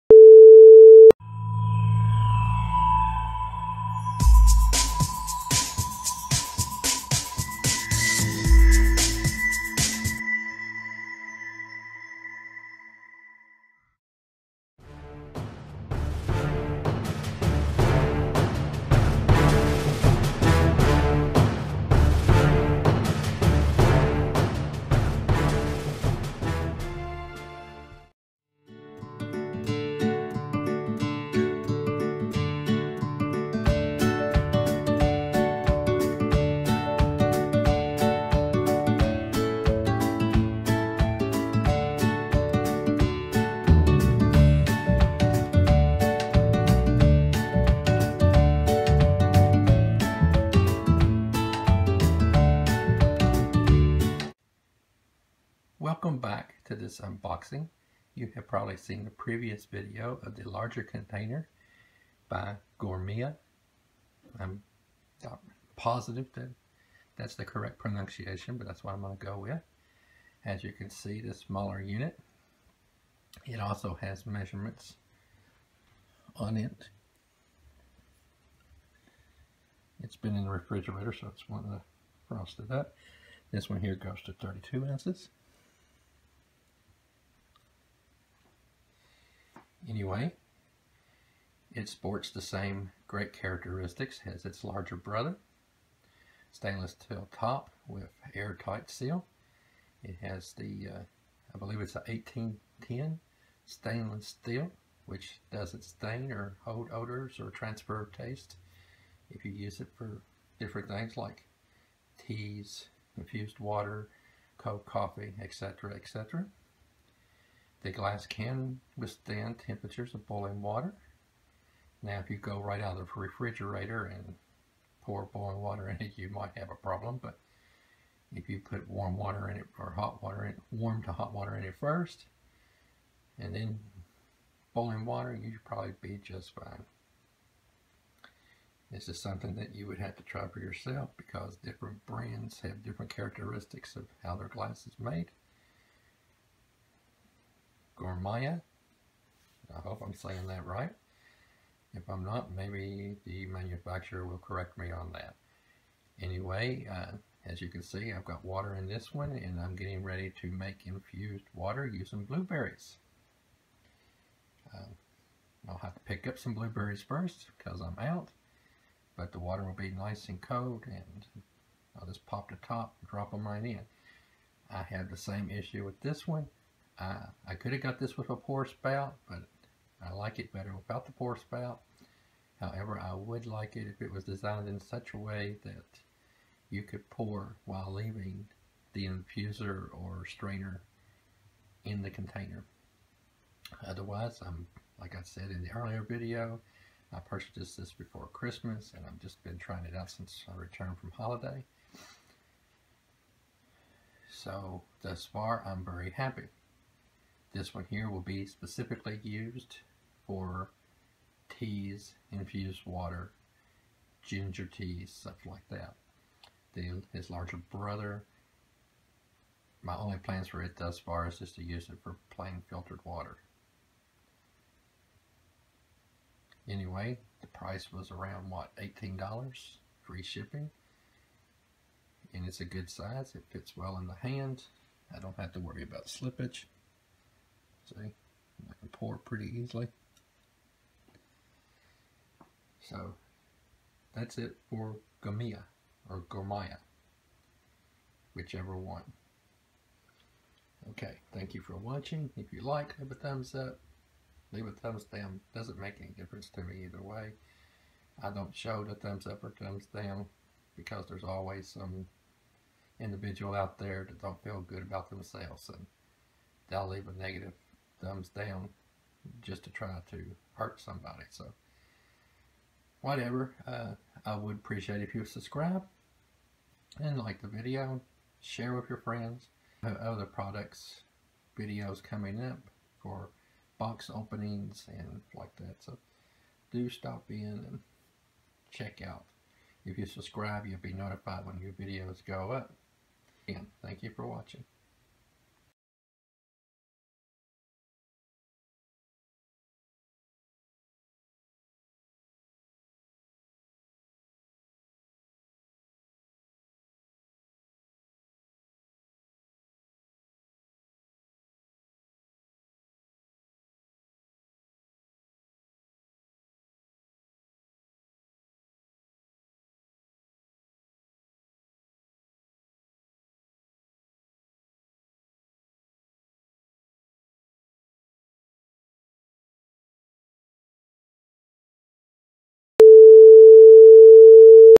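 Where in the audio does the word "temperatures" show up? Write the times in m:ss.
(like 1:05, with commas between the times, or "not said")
1:59.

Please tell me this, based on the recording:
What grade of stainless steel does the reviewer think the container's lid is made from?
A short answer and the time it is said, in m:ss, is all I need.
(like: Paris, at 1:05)
18/10, at 1:42.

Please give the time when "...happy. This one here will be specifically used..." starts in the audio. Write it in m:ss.
3:26.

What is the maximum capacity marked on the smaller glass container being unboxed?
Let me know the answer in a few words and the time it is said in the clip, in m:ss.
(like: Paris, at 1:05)
32 ounces, at 1:24.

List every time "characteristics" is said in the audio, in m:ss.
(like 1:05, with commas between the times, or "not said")
1:33, 2:23.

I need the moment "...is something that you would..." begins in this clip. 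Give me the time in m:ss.
2:19.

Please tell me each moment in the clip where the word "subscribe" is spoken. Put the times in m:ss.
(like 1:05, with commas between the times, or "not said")
4:35, 4:50.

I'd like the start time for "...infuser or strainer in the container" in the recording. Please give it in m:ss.
3:09.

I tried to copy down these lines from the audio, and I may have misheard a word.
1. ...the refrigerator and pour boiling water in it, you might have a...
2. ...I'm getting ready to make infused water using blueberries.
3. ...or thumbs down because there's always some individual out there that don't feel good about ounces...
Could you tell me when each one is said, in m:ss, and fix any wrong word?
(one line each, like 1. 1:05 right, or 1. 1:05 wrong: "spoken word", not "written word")
1. 2:03 right
2. 2:39 right
3. 4:19 wrong: "themselves", not "ounces".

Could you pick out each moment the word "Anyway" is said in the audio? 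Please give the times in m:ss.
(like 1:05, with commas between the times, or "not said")
1:29, 2:36, 3:46.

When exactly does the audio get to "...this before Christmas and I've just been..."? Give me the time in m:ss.
3:17.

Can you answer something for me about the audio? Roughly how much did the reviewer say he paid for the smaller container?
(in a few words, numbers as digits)
$18.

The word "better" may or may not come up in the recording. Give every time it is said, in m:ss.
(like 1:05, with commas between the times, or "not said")
3:00.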